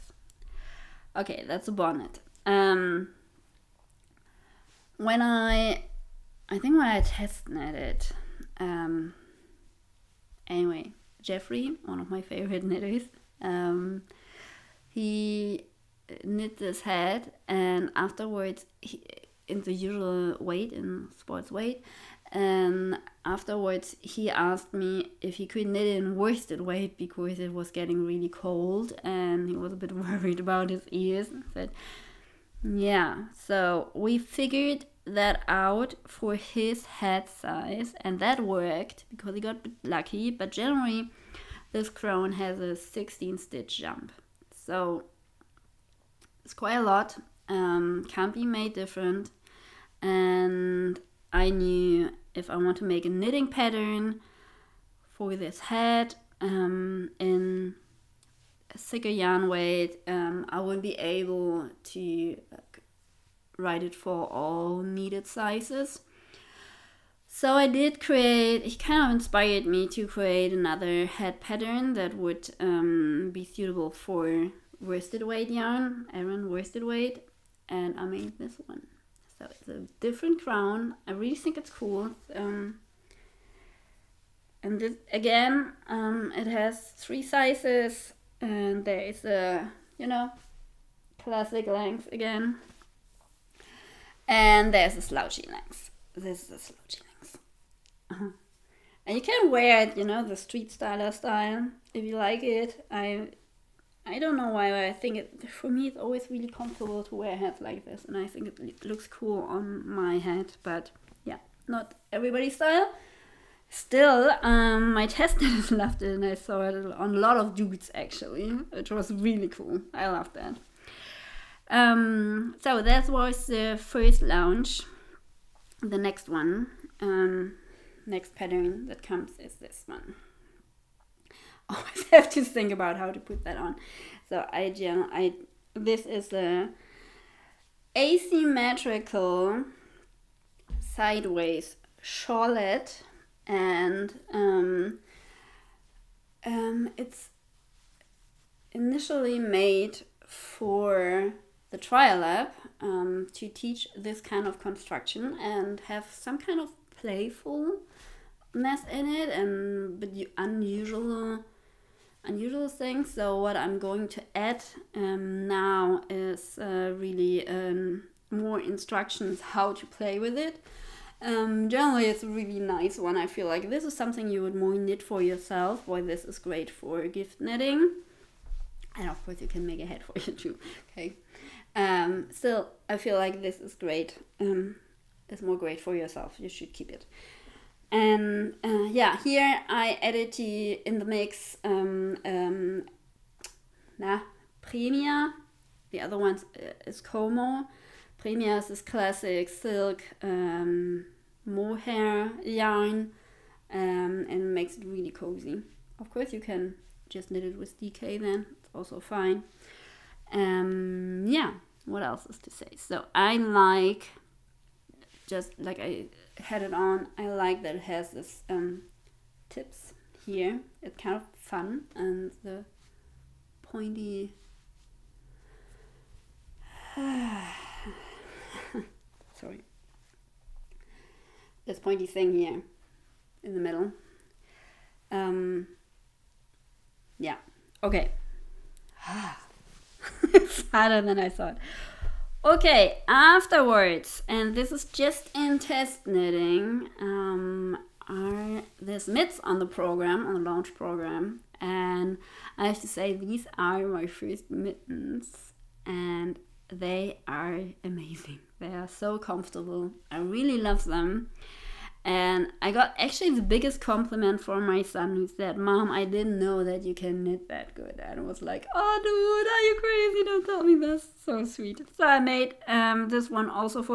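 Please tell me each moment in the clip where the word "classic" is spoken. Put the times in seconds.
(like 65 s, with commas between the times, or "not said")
91 s, 198 s.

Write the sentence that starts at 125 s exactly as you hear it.
The next one, um, next pattern that comes is this one.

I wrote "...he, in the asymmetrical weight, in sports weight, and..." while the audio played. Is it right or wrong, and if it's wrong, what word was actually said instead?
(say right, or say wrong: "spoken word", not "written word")
wrong: "usual", not "asymmetrical".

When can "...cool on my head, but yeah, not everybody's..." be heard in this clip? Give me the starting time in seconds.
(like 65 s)
109 s.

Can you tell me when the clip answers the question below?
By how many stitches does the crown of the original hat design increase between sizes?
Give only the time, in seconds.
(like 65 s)
42 s.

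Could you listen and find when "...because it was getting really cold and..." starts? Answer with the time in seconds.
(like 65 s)
26 s.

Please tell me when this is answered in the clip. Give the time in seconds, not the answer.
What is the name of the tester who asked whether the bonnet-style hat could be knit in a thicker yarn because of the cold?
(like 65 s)
11 s.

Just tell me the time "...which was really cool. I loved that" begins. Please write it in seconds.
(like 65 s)
118 s.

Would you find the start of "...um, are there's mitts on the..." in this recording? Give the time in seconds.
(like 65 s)
246 s.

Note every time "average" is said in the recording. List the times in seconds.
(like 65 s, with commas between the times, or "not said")
not said.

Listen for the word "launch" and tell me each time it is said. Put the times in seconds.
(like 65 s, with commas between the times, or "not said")
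124 s, 250 s.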